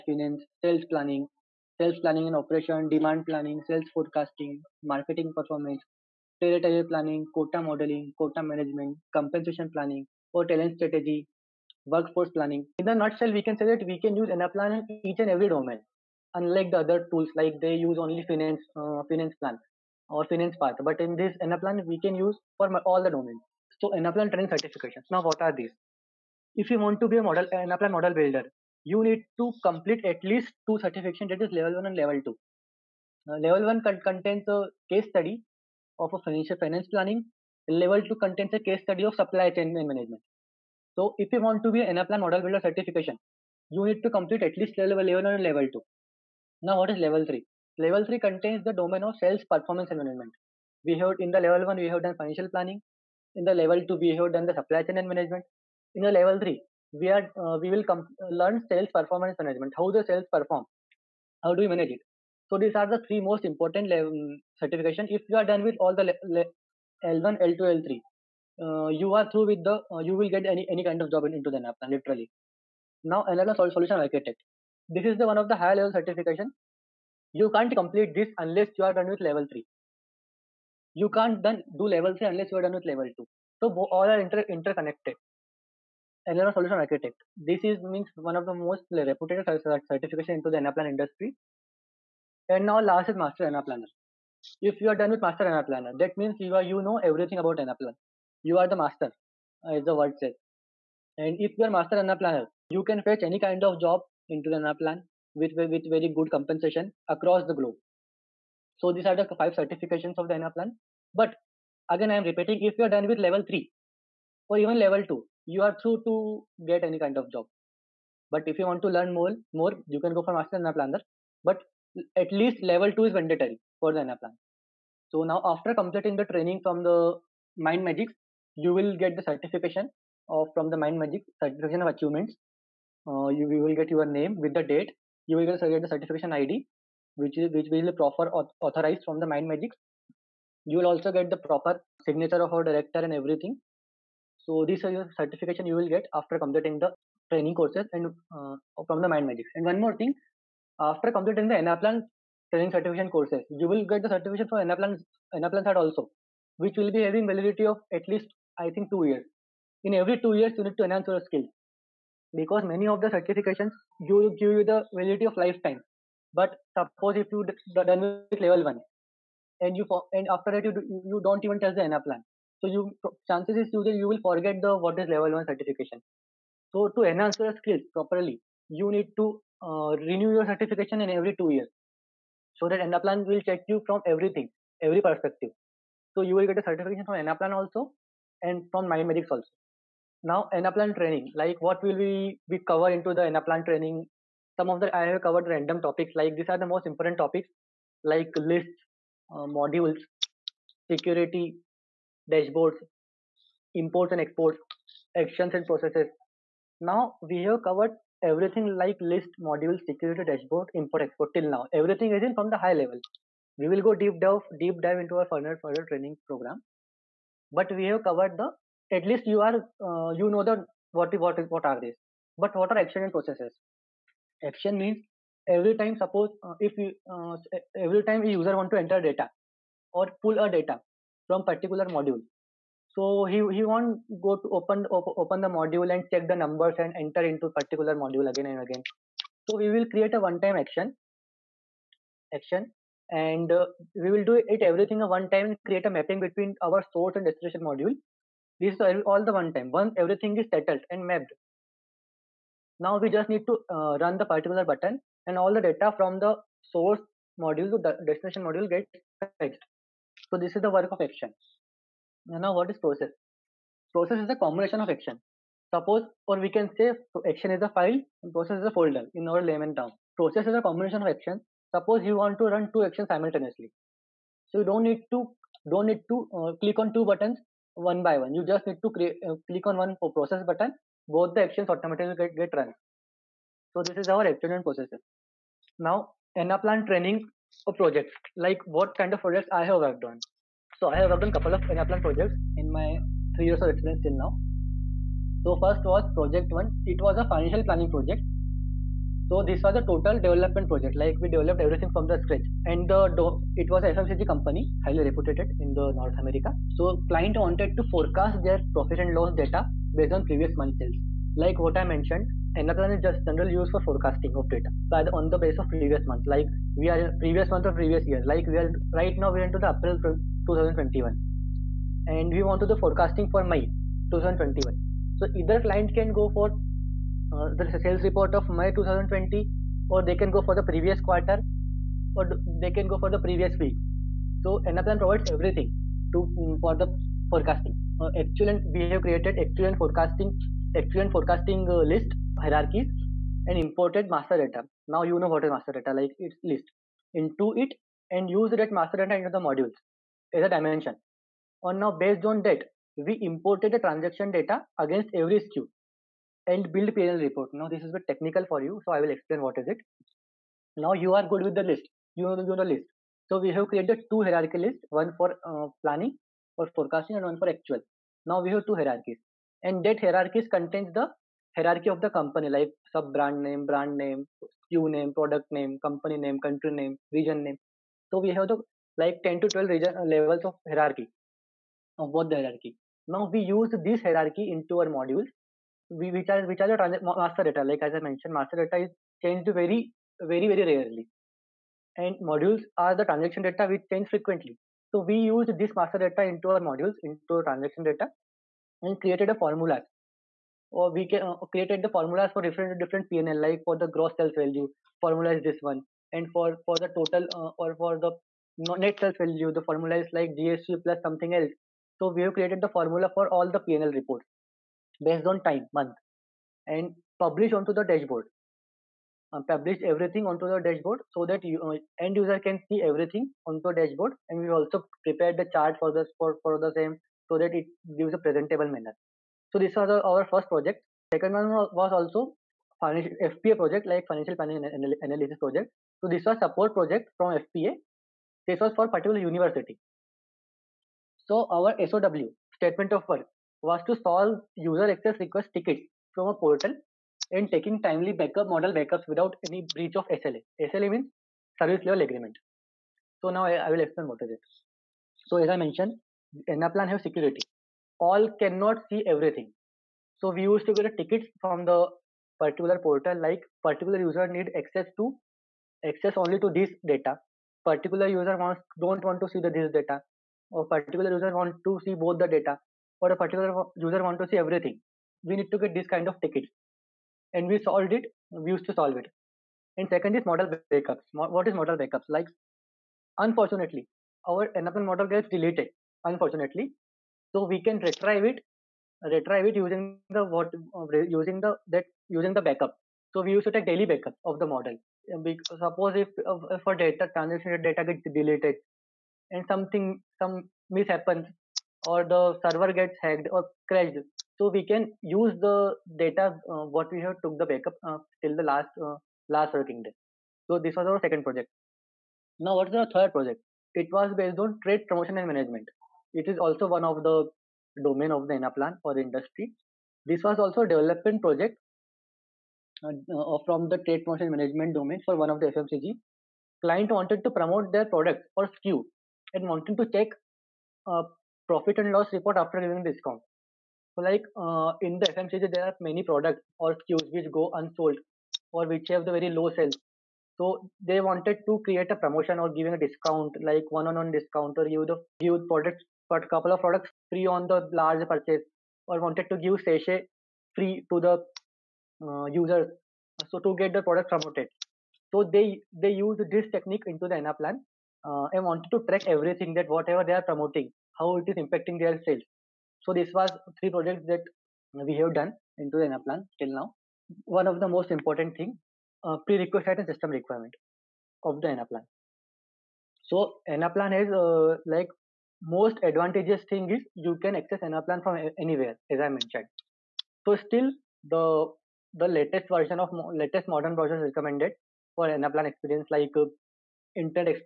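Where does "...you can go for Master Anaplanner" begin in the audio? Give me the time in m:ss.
1:59.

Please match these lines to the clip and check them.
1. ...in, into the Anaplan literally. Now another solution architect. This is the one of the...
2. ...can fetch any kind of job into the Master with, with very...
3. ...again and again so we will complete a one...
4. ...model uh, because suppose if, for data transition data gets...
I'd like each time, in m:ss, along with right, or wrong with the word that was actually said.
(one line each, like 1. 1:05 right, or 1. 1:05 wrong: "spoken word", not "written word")
1. 1:11 right
2. 1:42 wrong: "Anaplan", not "Master"
3. 3:58 wrong: "create", not "complete"
4. 8:14 right.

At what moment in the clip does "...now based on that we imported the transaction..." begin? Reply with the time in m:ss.
5:51.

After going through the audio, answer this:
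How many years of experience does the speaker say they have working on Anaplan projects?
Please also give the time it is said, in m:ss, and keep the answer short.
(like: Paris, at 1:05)
3 years, at 4:53.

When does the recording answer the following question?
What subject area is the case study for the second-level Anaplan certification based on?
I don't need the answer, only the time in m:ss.
0:39.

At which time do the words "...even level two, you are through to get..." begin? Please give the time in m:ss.
1:54.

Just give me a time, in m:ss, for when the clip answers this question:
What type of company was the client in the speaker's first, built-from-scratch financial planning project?
5:03.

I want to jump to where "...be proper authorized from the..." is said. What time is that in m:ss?
2:17.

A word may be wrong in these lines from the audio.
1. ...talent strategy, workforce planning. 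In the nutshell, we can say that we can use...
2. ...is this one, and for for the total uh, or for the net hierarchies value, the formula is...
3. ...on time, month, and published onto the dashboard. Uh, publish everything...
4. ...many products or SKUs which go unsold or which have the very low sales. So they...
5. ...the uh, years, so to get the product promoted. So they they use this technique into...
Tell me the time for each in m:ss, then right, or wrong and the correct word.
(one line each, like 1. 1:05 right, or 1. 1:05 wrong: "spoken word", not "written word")
1. 0:10 right
2. 6:45 wrong: "sales", not "hierarchies"
3. 6:55 right
4. 8:55 right
5. 9:11 wrong: "users", not "years".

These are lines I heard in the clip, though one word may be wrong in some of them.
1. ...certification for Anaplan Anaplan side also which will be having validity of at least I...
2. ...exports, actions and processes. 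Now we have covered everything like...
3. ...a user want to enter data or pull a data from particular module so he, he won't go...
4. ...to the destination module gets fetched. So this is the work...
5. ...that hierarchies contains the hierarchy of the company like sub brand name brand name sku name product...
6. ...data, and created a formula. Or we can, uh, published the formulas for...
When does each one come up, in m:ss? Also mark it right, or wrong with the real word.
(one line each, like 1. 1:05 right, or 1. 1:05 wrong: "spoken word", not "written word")
1. 2:34 right
2. 3:24 right
3. 3:48 right
4. 4:17 right
5. 6:09 right
6. 6:37 wrong: "created", not "published".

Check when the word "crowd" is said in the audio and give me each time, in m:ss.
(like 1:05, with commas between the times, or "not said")
not said.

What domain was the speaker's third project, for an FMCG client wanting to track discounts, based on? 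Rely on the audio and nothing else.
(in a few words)
Trade promotion management.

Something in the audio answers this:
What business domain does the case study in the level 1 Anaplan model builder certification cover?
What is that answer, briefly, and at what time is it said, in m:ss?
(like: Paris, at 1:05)
Finance planning, at 0:36.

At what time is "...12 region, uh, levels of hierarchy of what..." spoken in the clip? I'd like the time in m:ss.
6:19.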